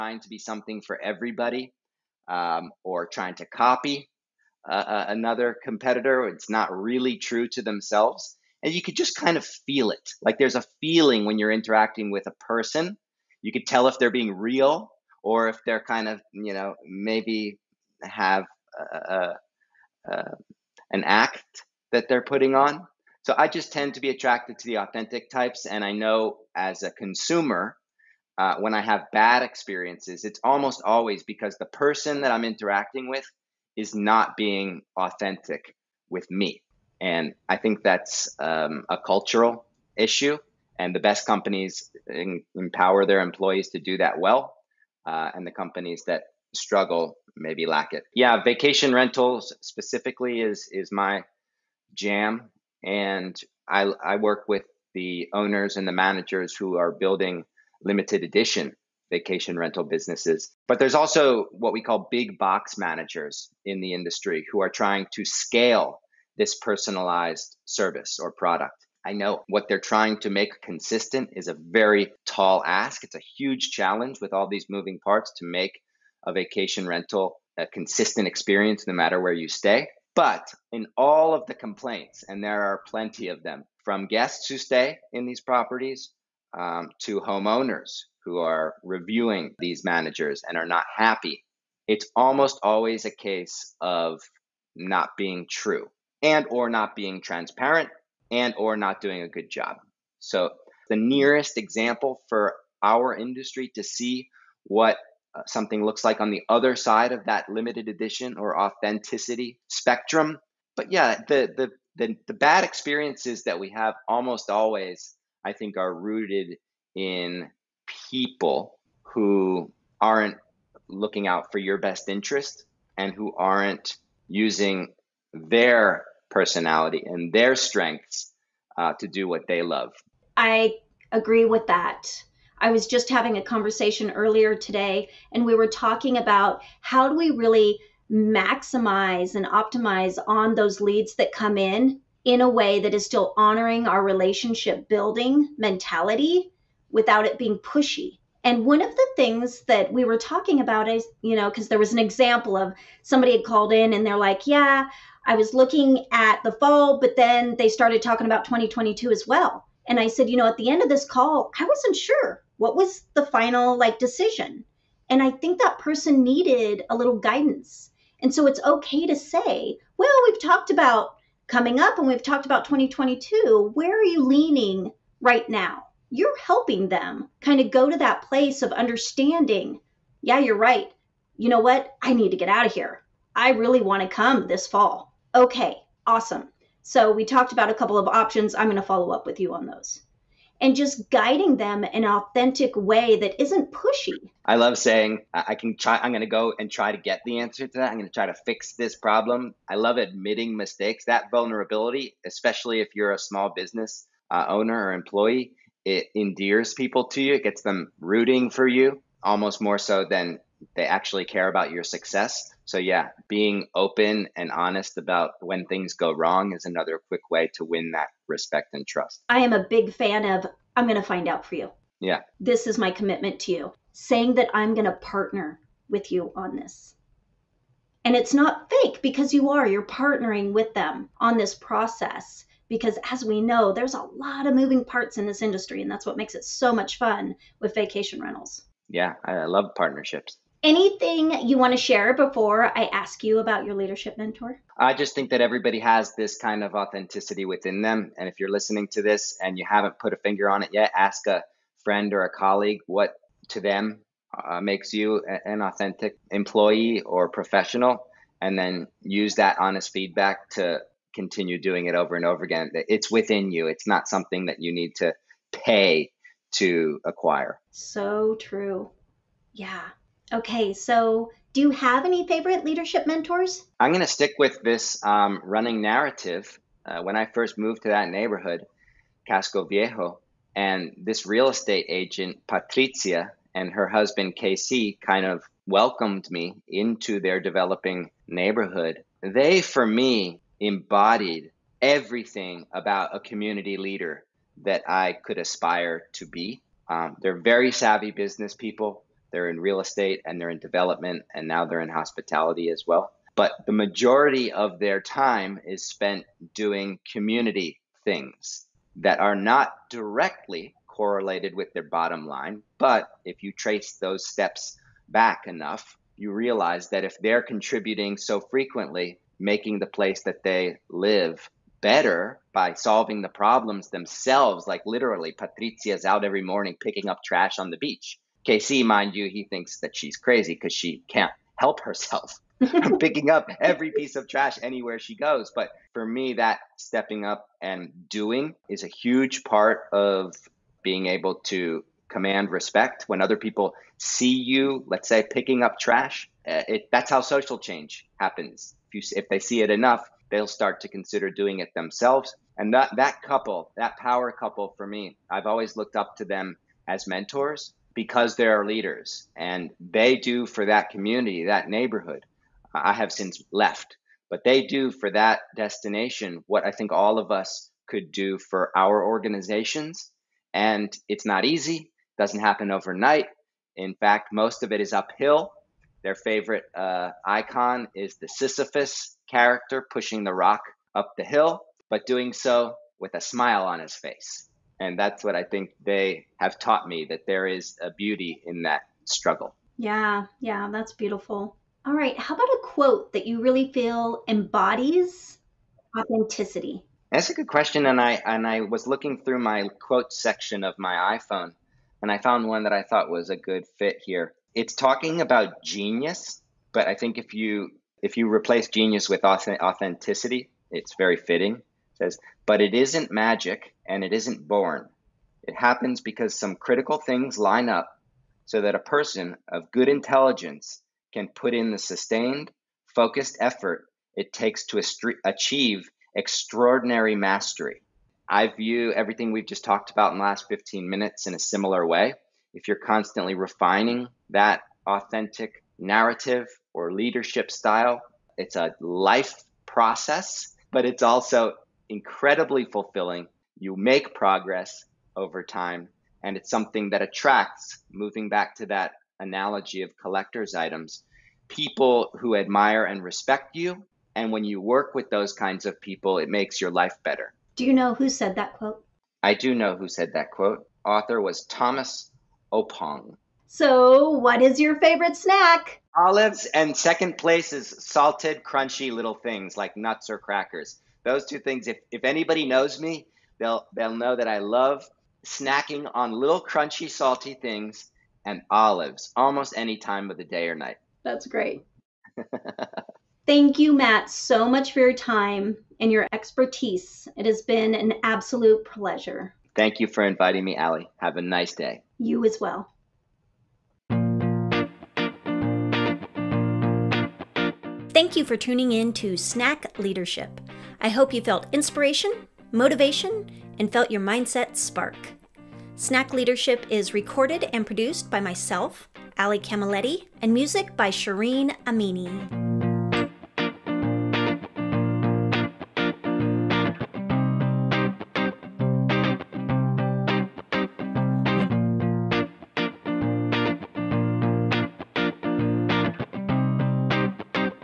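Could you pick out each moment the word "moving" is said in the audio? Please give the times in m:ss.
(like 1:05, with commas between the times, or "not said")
1:14, 3:54, 7:27.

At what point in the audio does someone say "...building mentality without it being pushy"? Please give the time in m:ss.
2:24.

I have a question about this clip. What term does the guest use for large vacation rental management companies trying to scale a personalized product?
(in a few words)
Big box managers.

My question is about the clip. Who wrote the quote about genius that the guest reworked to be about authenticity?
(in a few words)
Thomas Oppong.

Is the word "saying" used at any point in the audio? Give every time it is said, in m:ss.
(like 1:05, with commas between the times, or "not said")
3:14, 3:43.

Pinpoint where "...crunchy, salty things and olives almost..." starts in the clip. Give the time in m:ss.
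7:56.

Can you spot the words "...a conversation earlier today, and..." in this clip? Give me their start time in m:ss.
2:13.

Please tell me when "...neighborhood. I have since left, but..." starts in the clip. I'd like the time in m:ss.
6:01.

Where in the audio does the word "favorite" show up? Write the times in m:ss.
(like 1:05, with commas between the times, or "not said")
4:32, 6:16, 7:44.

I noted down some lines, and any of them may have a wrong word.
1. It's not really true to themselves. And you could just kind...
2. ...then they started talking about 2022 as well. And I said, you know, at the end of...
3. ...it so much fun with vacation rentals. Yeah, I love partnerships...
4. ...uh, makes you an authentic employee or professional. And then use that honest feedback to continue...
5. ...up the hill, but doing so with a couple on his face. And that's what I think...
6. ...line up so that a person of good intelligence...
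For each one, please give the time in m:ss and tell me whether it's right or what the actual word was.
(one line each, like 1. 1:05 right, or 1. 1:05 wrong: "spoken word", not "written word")
1. 0:06 right
2. 2:37 right
3. 3:56 right
4. 4:14 right
5. 6:20 wrong: "smile", not "couple"
6. 6:57 right.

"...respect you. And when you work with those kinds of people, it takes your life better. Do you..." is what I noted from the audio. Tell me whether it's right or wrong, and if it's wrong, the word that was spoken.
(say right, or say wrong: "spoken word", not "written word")
wrong: "makes", not "takes".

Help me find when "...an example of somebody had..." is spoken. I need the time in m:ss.
2:31.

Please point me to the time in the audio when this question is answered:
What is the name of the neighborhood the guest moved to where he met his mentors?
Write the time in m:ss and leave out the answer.
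4:39.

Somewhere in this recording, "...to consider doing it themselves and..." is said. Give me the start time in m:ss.
5:50.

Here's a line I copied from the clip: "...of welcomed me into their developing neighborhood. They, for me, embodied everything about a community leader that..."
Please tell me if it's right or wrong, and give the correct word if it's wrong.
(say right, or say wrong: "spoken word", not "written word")
right.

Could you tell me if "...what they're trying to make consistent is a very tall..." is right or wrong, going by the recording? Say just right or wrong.
right.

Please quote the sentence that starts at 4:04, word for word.
I just think that everybody has this kind of authenticity within them.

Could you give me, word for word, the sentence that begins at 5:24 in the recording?
Like literally, Patricia's out every morning picking up trash on the beach.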